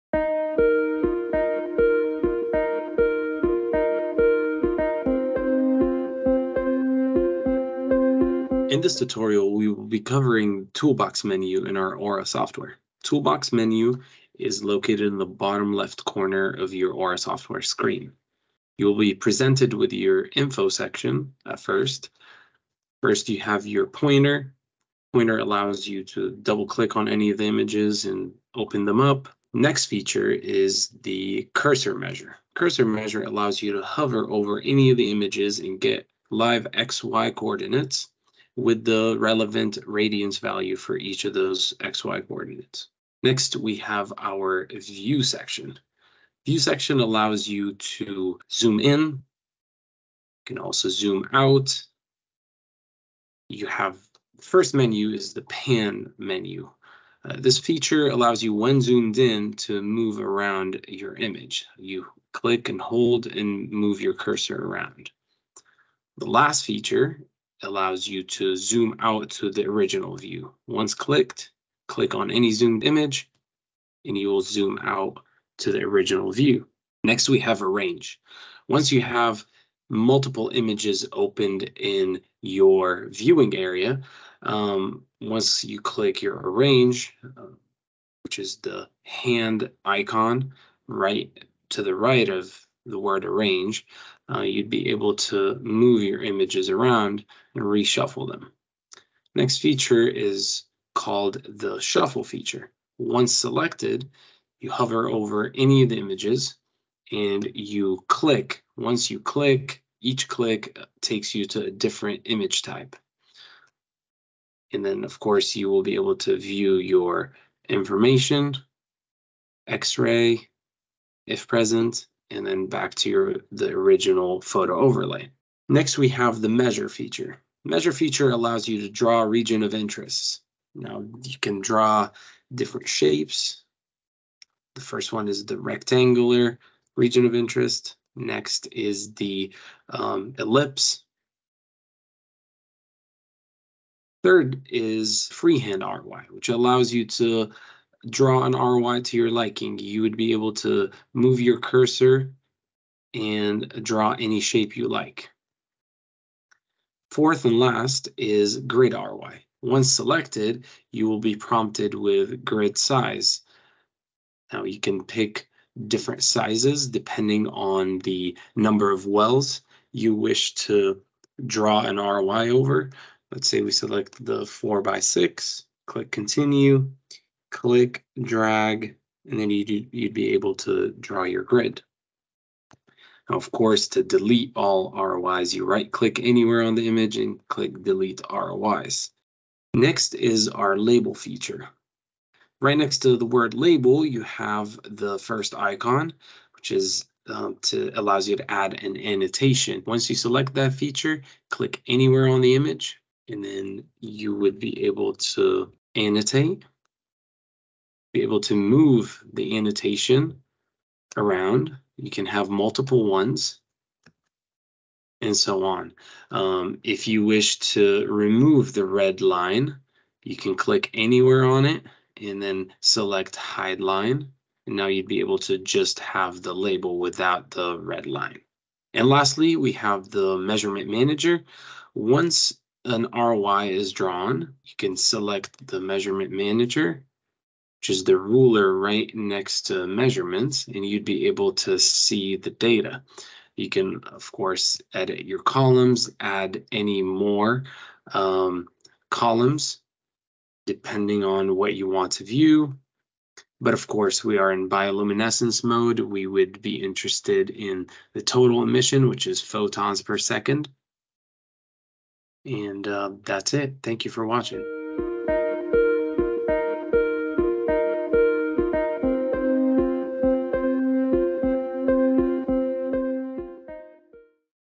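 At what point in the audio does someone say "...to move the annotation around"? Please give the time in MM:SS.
03:28.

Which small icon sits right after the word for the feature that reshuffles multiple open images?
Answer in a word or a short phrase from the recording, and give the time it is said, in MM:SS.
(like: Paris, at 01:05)
Hand icon, at 01:29.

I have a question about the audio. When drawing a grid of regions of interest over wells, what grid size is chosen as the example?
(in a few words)
4 by 6.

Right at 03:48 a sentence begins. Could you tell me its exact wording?
And lastly, we have the measurement manager.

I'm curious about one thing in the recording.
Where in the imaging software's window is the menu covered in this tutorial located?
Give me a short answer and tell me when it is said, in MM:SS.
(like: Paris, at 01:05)
Bottom left corner, at 00:15.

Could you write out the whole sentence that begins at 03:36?
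Um, if you wish to remove the red line, you can click anywhere on it and then select hide line.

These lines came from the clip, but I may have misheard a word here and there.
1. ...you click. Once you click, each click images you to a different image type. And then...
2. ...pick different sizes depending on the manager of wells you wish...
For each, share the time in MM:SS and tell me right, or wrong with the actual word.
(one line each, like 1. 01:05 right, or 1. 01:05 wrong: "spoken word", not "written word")
1. 01:47 wrong: "takes", not "images"
2. 02:45 wrong: "number", not "manager".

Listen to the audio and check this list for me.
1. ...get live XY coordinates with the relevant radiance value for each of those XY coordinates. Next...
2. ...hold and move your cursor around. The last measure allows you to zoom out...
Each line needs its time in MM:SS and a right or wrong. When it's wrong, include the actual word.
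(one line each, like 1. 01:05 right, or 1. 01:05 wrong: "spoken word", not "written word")
1. 00:35 right
2. 01:02 wrong: "feature", not "measure".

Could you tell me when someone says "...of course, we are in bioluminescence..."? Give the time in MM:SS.
04:13.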